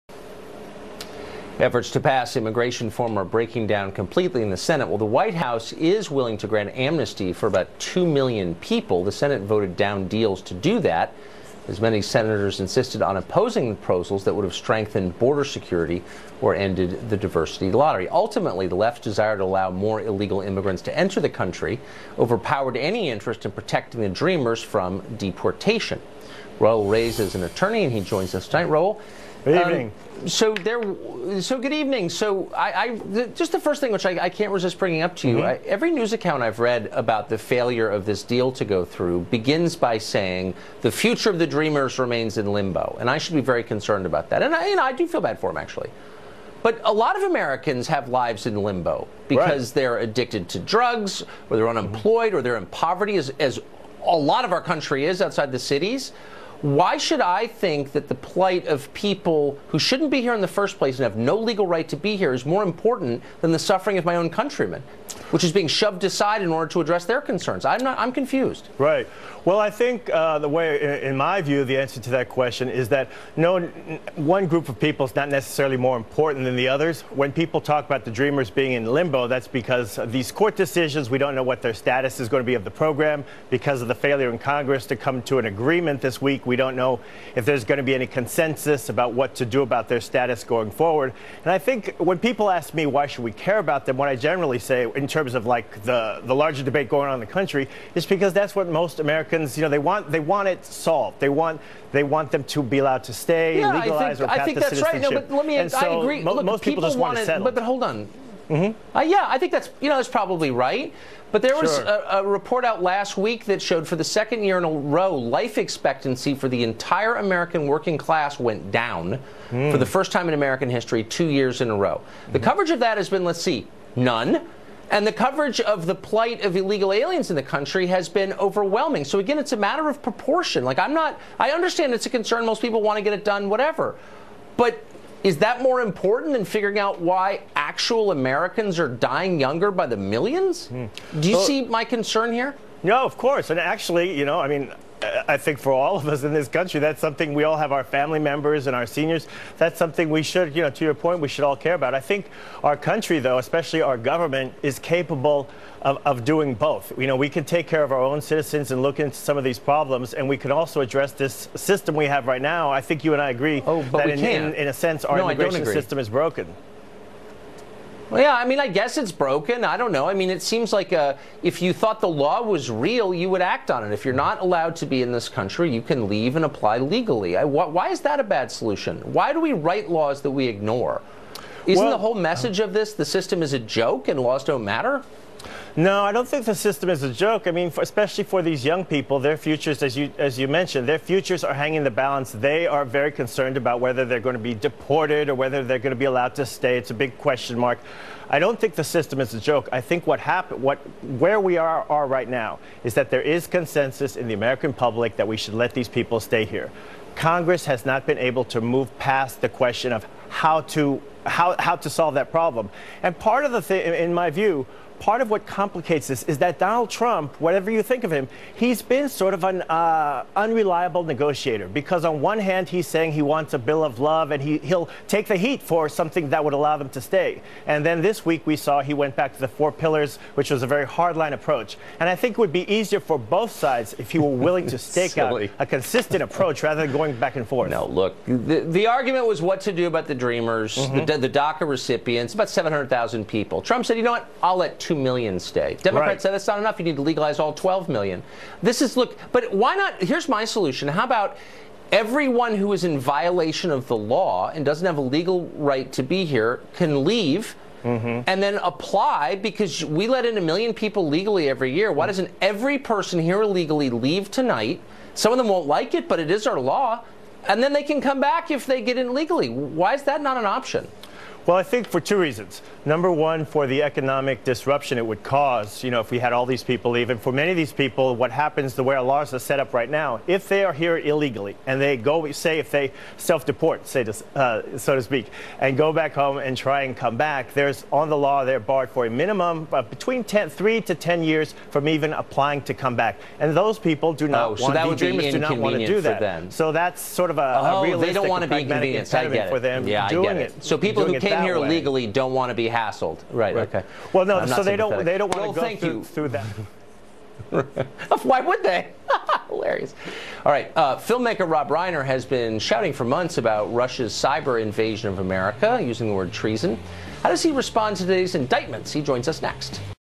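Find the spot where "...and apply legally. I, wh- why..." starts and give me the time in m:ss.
2:56.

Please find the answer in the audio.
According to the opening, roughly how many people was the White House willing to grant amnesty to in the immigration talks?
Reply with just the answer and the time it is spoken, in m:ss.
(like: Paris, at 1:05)
2 million, at 0:07.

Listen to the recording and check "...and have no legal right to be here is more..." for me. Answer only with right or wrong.
right.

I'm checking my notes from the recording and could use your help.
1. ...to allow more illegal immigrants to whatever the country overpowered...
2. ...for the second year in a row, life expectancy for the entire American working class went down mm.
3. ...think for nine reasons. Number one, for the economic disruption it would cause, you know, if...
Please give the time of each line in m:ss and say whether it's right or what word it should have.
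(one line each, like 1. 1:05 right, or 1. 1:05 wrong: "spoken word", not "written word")
1. 0:19 wrong: "enter", not "whatever"
2. 1:53 right
3. 4:31 wrong: "two", not "nine".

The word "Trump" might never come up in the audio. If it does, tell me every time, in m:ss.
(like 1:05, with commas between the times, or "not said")
3:36, 4:03.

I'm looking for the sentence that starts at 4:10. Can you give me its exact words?
How about everyone who is in violation of the law and doesn't have a legal right to be here can leave?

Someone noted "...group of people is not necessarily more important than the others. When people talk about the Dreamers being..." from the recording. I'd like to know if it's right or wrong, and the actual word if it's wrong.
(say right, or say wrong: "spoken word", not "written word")
right.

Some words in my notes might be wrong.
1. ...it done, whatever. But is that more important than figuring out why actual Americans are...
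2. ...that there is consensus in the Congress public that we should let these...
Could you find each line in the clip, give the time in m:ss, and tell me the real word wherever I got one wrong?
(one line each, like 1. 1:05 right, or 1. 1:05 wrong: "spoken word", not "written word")
1. 2:13 right
2. 3:22 wrong: "American", not "Congress".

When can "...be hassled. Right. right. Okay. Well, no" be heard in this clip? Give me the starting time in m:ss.
5:02.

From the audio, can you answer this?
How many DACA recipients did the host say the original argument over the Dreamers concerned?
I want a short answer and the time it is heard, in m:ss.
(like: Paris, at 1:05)
700,000, at 4:02.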